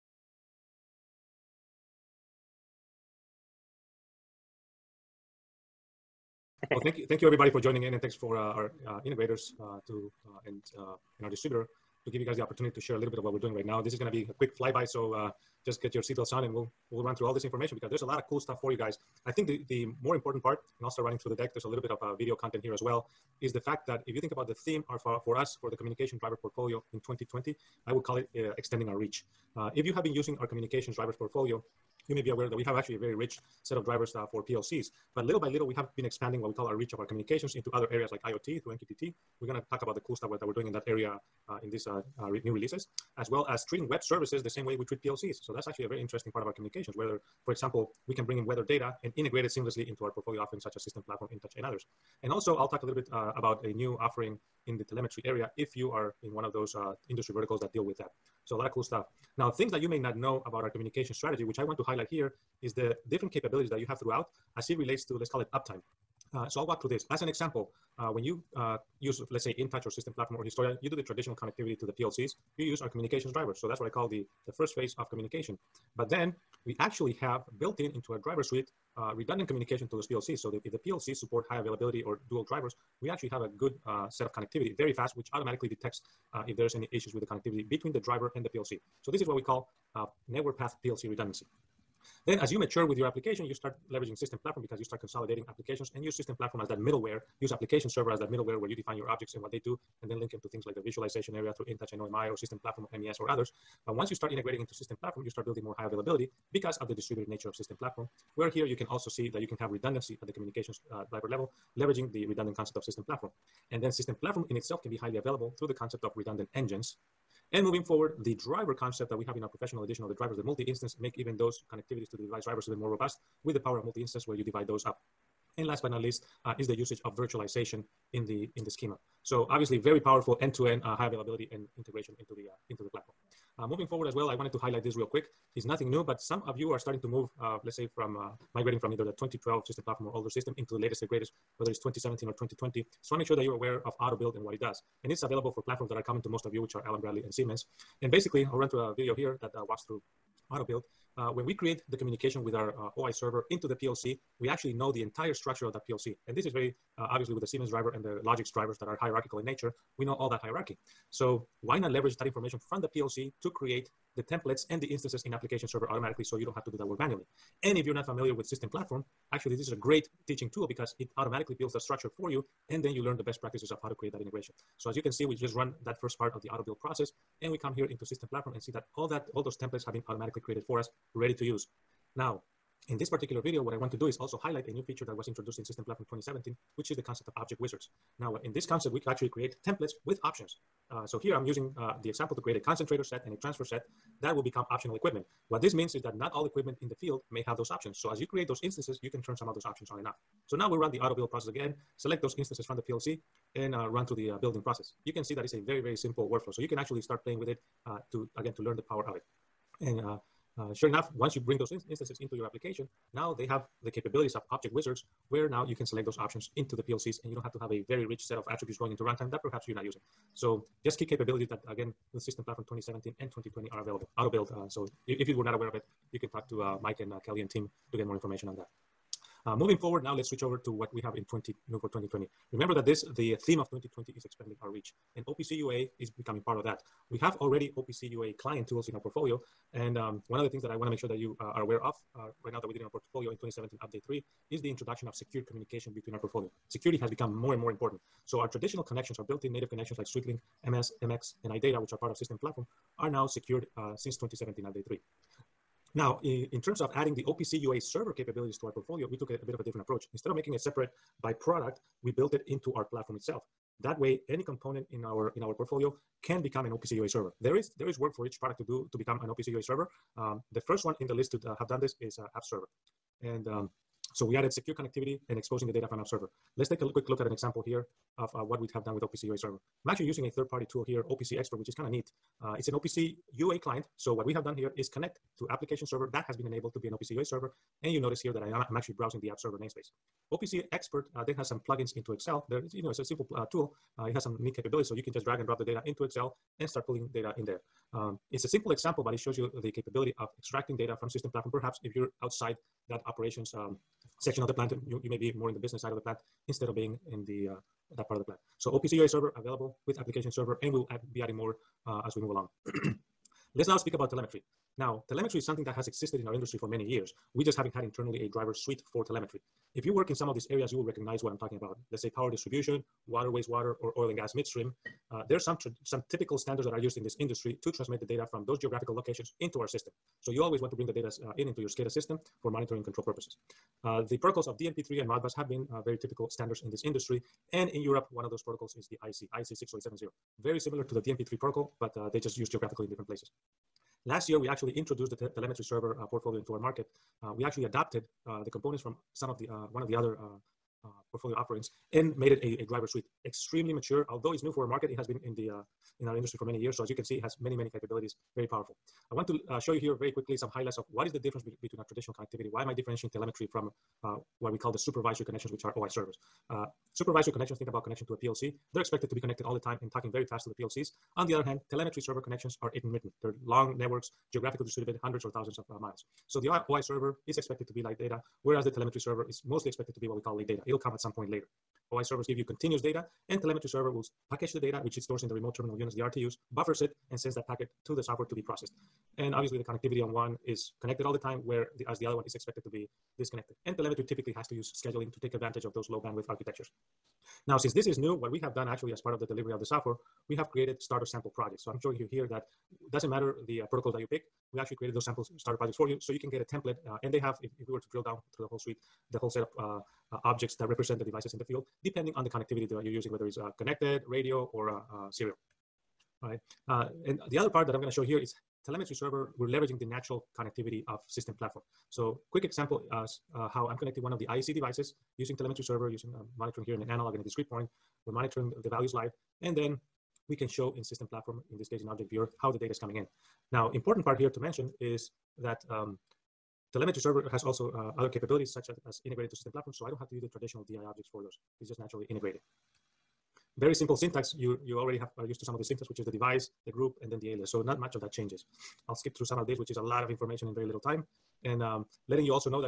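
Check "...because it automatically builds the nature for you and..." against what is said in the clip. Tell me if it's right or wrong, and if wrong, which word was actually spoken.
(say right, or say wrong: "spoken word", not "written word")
wrong: "structure", not "nature".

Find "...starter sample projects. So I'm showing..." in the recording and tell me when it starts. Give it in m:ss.
6:40.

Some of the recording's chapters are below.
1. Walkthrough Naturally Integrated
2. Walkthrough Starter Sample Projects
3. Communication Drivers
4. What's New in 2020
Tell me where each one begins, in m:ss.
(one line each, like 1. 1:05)
1. 6:56
2. 6:37
3. 0:06
4. 3:49.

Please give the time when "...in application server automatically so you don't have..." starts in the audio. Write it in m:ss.
2:45.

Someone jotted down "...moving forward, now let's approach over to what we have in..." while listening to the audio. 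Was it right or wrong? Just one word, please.
wrong.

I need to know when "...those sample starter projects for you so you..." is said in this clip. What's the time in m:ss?
6:44.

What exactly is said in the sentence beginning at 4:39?
I'm actually using a third-party tool here, OPC Expert, which is kind of neat.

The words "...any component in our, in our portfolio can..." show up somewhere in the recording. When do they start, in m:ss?
4:24.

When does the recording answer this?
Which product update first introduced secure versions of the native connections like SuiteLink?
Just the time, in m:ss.
4:03.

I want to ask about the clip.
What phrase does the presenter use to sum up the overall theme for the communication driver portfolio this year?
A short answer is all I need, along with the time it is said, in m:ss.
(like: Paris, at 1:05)
Extending our reach, at 0:28.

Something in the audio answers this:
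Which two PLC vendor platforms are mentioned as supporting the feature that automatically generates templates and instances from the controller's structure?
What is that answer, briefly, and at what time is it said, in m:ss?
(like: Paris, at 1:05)
Allen Bradley and Siemens, at 2:26.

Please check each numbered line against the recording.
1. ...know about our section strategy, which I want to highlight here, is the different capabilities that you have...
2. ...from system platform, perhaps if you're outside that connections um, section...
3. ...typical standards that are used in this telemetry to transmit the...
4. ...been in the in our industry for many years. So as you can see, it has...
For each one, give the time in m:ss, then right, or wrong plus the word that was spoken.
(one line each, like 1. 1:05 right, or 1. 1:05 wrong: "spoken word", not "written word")
1. 1:00 wrong: "communication", not "section"
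2. 5:00 wrong: "operations", not "connections"
3. 5:26 wrong: "industry", not "telemetry"
4. 5:55 right.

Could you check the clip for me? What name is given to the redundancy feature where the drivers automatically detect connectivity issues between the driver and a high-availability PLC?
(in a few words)
Network path PLC redundancy.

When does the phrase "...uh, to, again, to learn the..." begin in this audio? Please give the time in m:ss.
3:27.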